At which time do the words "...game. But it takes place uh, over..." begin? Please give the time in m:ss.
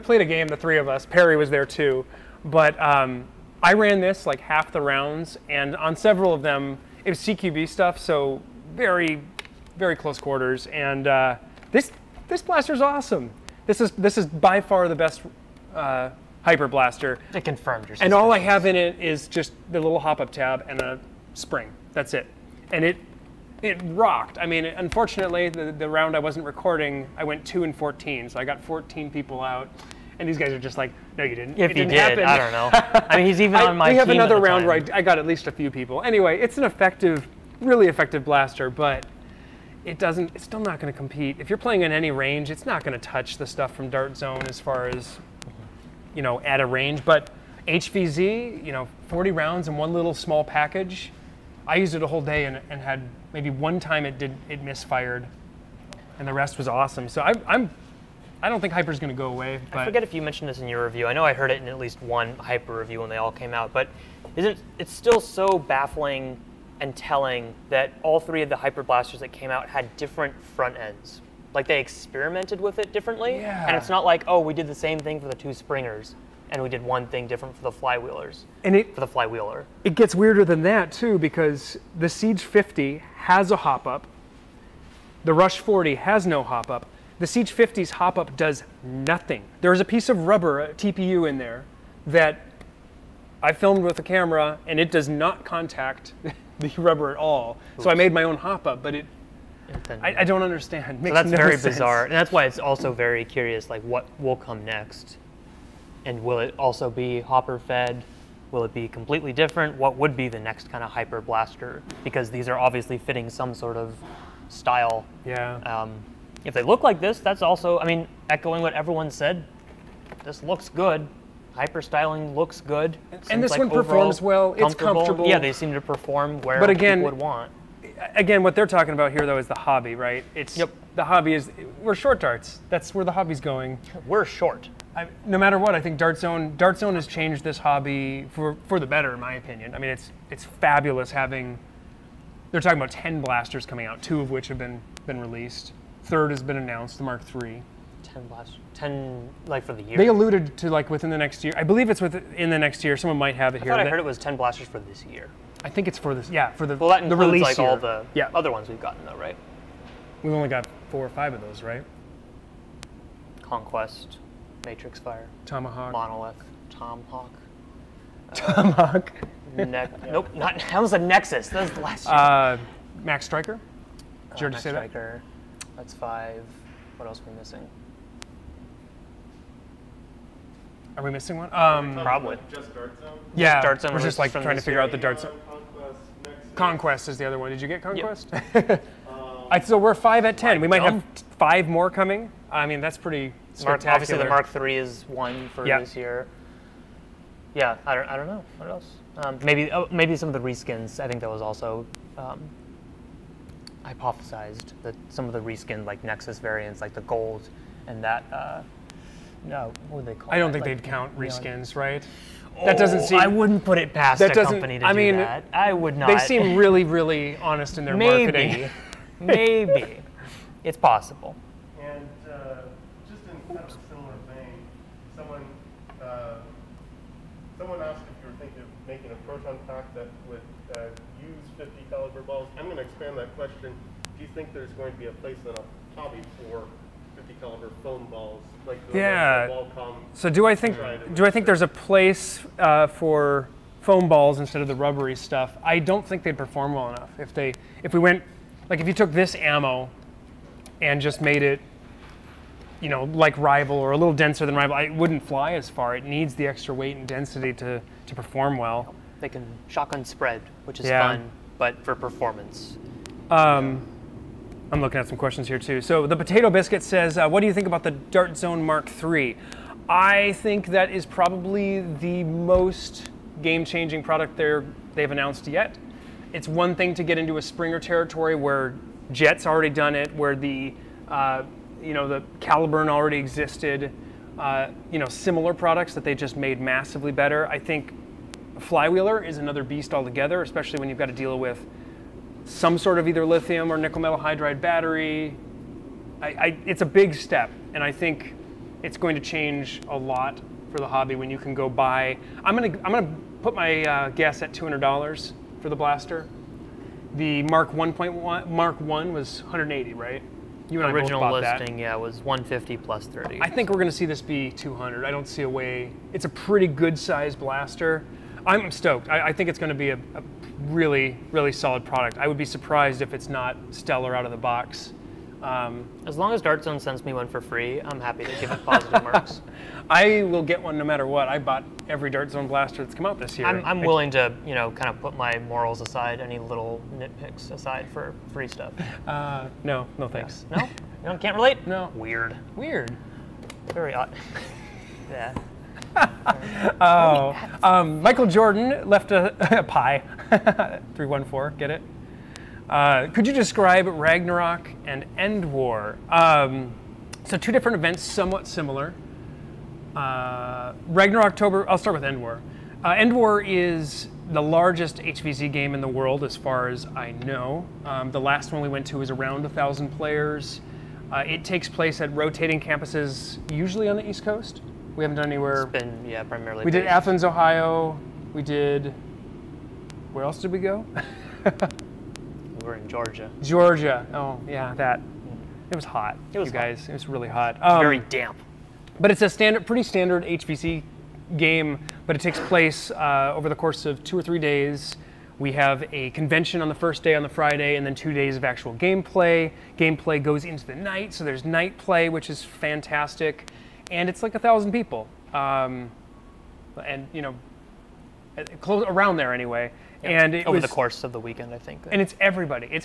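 6:31.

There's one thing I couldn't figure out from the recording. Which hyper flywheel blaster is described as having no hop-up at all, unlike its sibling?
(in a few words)
Rush 40.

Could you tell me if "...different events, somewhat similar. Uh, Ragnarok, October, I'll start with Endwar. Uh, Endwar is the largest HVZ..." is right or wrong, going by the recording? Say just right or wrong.
right.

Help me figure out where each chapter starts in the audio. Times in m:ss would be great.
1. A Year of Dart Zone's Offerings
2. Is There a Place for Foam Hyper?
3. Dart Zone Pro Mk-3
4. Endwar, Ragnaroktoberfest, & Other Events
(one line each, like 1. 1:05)
1. 2:13
2. 3:00
3. 4:25
4. 5:52.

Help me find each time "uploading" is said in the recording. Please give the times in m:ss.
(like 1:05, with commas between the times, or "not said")
not said.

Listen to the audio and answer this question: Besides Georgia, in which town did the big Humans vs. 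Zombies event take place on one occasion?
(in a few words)
Athens, Ohio.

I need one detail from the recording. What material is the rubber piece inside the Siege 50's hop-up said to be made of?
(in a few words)
TPU.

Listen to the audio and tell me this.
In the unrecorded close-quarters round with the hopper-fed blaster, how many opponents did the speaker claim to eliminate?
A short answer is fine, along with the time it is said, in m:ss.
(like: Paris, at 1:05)
14, at 0:28.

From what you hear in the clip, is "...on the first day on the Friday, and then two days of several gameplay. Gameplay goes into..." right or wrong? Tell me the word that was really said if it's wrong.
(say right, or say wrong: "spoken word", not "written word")
wrong: "actual", not "several".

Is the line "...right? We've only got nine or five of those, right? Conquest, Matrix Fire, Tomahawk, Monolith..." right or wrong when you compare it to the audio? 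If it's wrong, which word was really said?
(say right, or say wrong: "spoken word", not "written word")
wrong: "four", not "nine".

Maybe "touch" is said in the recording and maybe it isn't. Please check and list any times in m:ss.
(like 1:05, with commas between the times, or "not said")
0:42.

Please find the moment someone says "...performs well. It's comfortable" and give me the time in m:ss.
2:03.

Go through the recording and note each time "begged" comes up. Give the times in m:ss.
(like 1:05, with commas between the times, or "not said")
not said.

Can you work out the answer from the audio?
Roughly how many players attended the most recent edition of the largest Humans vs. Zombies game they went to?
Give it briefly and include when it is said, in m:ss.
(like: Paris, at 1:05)
1,000, at 6:09.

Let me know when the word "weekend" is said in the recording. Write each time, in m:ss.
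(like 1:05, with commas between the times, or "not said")
6:51.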